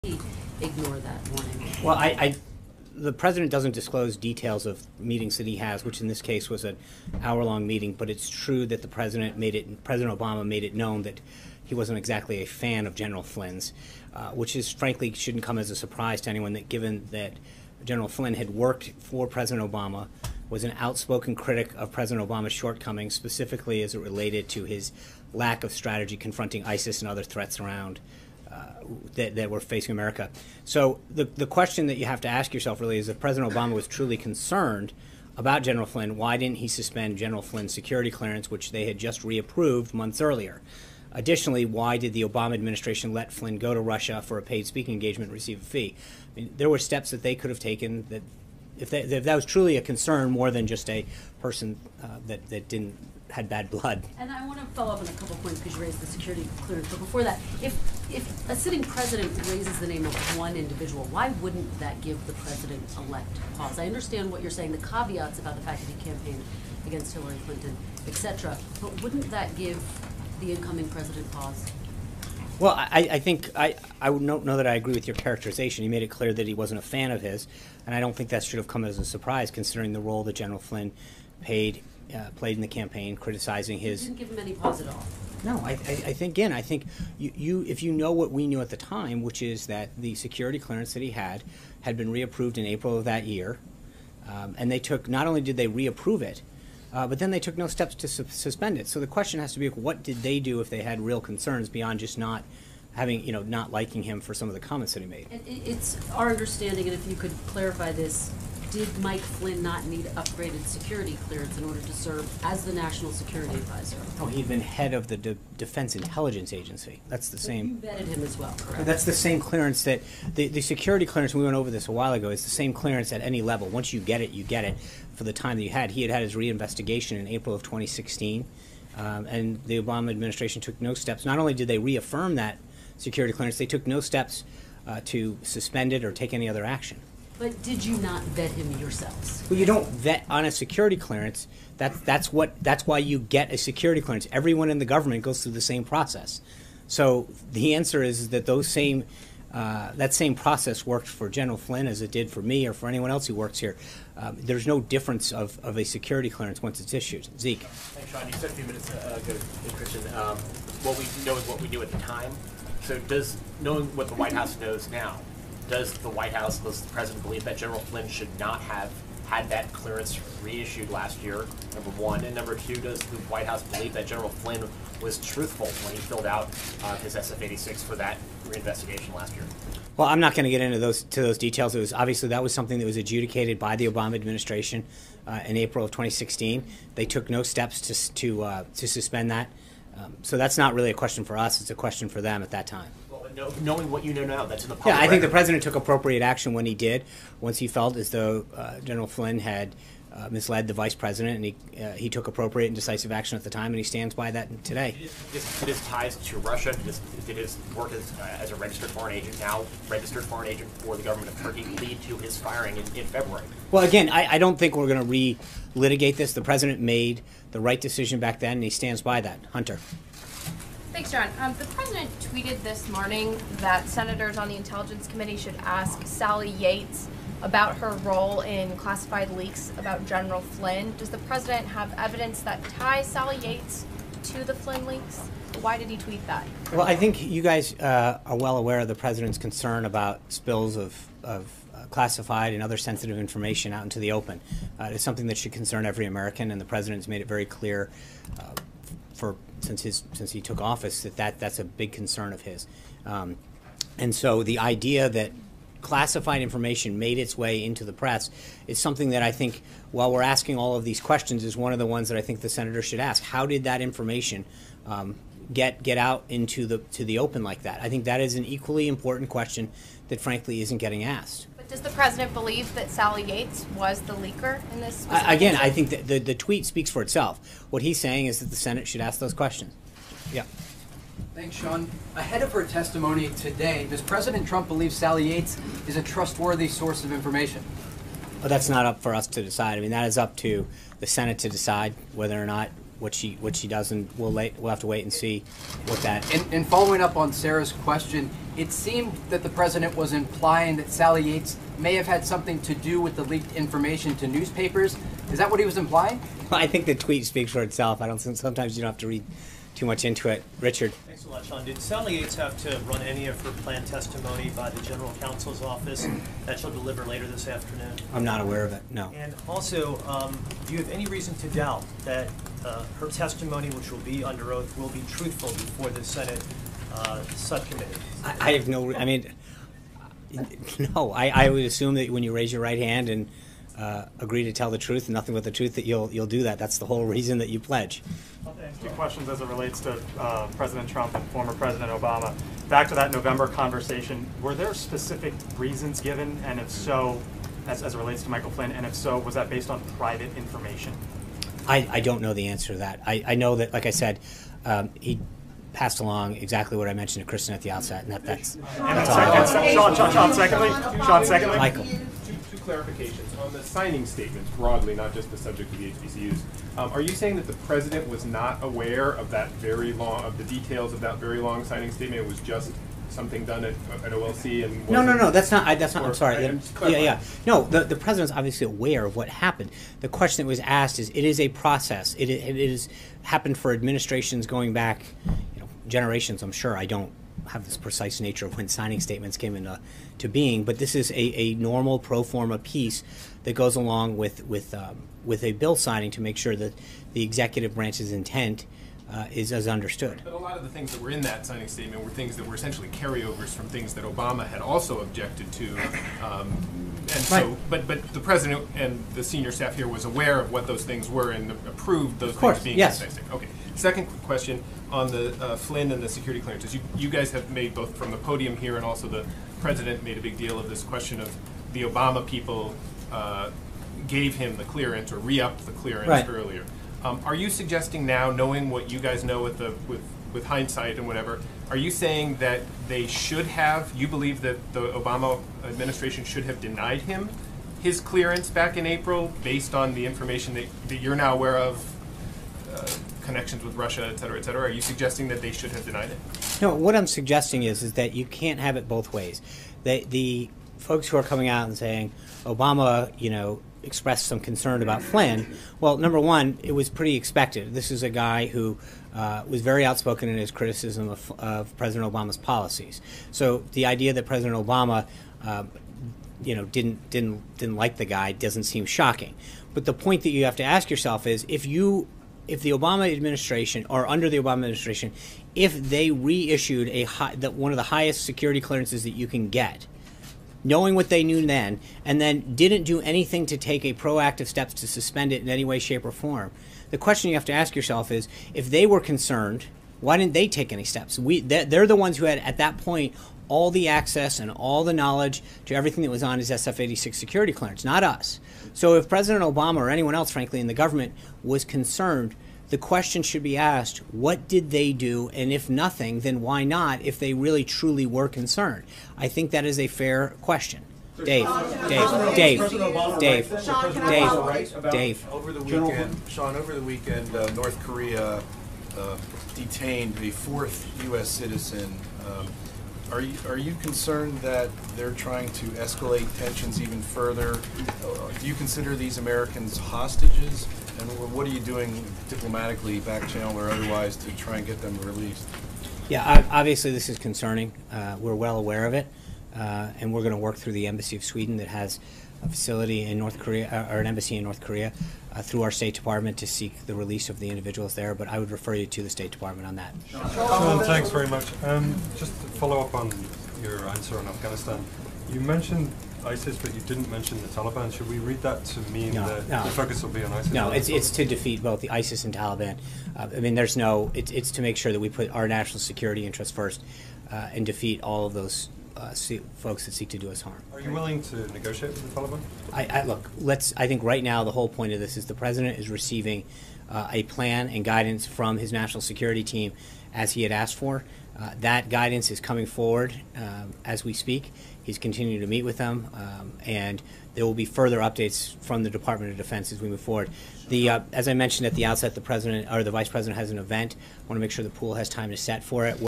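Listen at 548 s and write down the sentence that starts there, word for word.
But I would refer you to the State Department on that.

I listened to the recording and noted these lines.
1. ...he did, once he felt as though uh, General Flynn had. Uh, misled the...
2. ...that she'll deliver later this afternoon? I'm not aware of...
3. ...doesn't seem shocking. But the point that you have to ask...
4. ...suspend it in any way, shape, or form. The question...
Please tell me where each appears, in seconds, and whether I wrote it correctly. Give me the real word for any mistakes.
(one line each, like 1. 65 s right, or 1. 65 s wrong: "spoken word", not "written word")
1. 196 s right
2. 316 s right
3. 468 s right
4. 484 s right.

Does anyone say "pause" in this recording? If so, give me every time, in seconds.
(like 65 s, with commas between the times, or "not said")
63 s, 71 s, 84 s.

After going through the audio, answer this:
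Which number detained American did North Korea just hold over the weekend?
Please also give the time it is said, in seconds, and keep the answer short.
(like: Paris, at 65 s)
fourth, at 520 s.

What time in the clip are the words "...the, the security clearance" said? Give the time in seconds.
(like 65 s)
120 s.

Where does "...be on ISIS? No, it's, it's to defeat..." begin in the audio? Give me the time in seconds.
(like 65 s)
560 s.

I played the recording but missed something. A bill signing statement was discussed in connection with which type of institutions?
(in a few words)
HBCUs.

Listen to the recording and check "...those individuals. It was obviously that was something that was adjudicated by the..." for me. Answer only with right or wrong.
wrong.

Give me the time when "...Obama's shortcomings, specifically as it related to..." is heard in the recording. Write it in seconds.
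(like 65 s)
22 s.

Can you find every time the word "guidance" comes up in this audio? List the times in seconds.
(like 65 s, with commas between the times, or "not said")
577 s, 581 s.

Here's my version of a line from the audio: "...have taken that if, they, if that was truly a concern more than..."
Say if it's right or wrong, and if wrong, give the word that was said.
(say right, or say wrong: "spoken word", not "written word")
right.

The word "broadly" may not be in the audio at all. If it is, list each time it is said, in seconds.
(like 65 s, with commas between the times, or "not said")
364 s.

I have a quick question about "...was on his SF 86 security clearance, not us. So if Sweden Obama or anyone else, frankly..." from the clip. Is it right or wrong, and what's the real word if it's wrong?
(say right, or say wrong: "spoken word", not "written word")
wrong: "President", not "Sweden".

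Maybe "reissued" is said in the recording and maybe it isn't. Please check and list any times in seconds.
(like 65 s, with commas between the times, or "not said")
170 s, 476 s.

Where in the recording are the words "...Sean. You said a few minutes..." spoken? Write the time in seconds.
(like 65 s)
158 s.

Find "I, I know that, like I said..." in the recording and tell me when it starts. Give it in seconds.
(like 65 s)
353 s.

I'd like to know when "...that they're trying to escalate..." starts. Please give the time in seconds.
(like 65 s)
524 s.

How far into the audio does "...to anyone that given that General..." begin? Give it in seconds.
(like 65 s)
16 s.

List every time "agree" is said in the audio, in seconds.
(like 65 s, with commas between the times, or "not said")
74 s, 334 s.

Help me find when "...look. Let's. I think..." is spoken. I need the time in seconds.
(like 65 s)
573 s.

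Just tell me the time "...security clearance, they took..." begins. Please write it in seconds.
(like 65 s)
132 s.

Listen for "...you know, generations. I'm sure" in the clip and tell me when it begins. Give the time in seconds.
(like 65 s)
385 s.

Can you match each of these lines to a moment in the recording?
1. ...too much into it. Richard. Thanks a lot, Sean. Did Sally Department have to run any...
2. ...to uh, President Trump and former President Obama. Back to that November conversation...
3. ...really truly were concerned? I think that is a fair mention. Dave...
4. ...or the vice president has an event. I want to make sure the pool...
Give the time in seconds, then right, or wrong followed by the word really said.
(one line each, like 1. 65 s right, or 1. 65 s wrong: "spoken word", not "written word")
1. 309 s wrong: "Yates", not "Department"
2. 339 s right
3. 507 s wrong: "question", not "mention"
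4. 592 s right.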